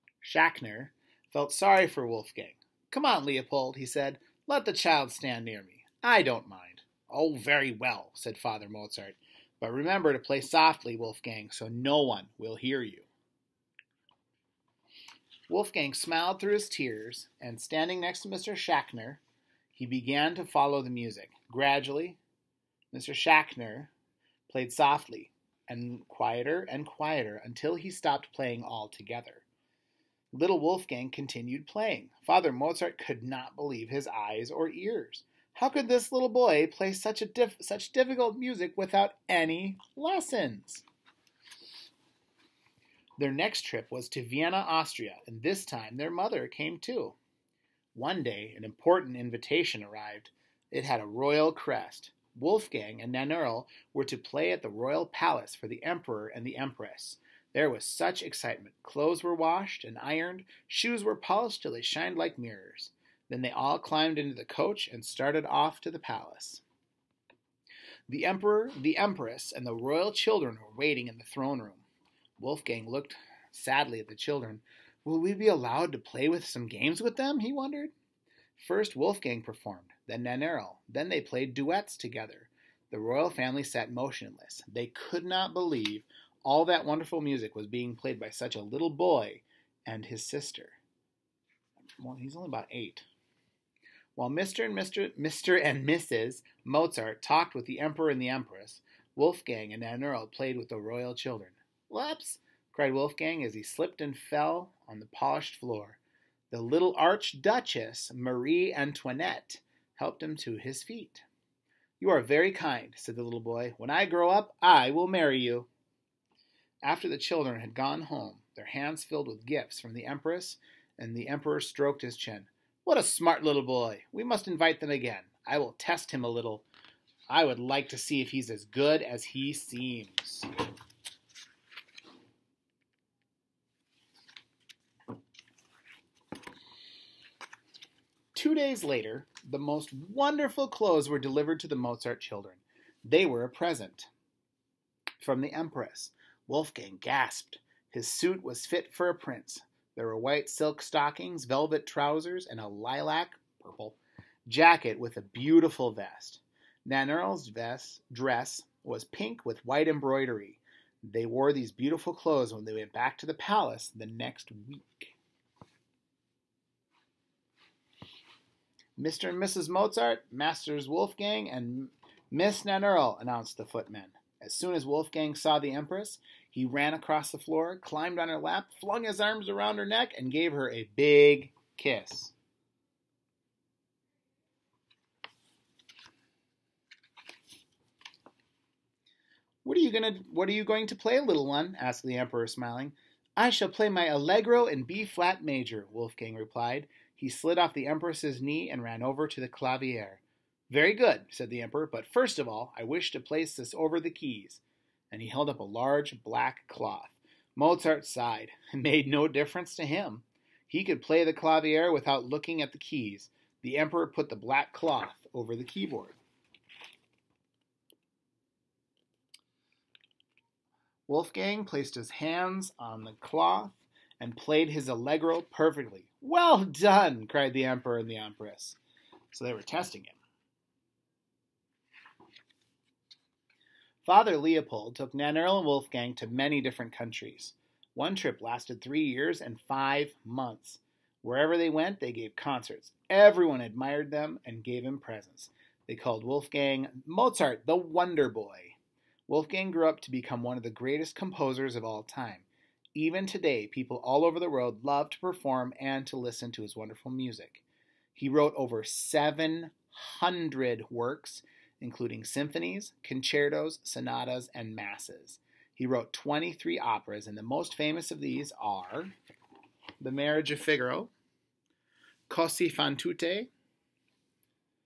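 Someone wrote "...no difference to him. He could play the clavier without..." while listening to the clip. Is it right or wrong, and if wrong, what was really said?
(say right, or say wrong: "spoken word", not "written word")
right.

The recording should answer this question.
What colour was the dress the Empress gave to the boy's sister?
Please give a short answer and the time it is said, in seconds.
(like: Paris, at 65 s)
Pink, at 159 s.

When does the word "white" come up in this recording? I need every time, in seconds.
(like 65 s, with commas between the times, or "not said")
150 s, 159 s.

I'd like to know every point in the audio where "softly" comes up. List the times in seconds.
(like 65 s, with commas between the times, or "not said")
10 s, 24 s.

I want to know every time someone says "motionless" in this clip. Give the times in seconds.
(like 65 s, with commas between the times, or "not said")
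83 s.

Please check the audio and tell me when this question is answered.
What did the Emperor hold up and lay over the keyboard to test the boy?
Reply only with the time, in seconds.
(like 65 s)
205 s.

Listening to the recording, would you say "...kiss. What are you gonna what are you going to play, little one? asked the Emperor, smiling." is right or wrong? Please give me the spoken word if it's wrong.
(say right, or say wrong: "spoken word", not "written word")
right.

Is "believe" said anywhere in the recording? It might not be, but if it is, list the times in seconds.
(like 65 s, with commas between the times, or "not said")
33 s, 85 s.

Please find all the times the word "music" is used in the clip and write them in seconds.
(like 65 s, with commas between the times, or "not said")
20 s, 38 s, 87 s, 257 s.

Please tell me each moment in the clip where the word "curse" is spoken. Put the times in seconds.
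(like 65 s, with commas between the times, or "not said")
not said.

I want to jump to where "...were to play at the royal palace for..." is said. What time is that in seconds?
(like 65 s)
53 s.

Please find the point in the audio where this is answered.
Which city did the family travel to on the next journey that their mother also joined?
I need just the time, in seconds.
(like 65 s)
44 s.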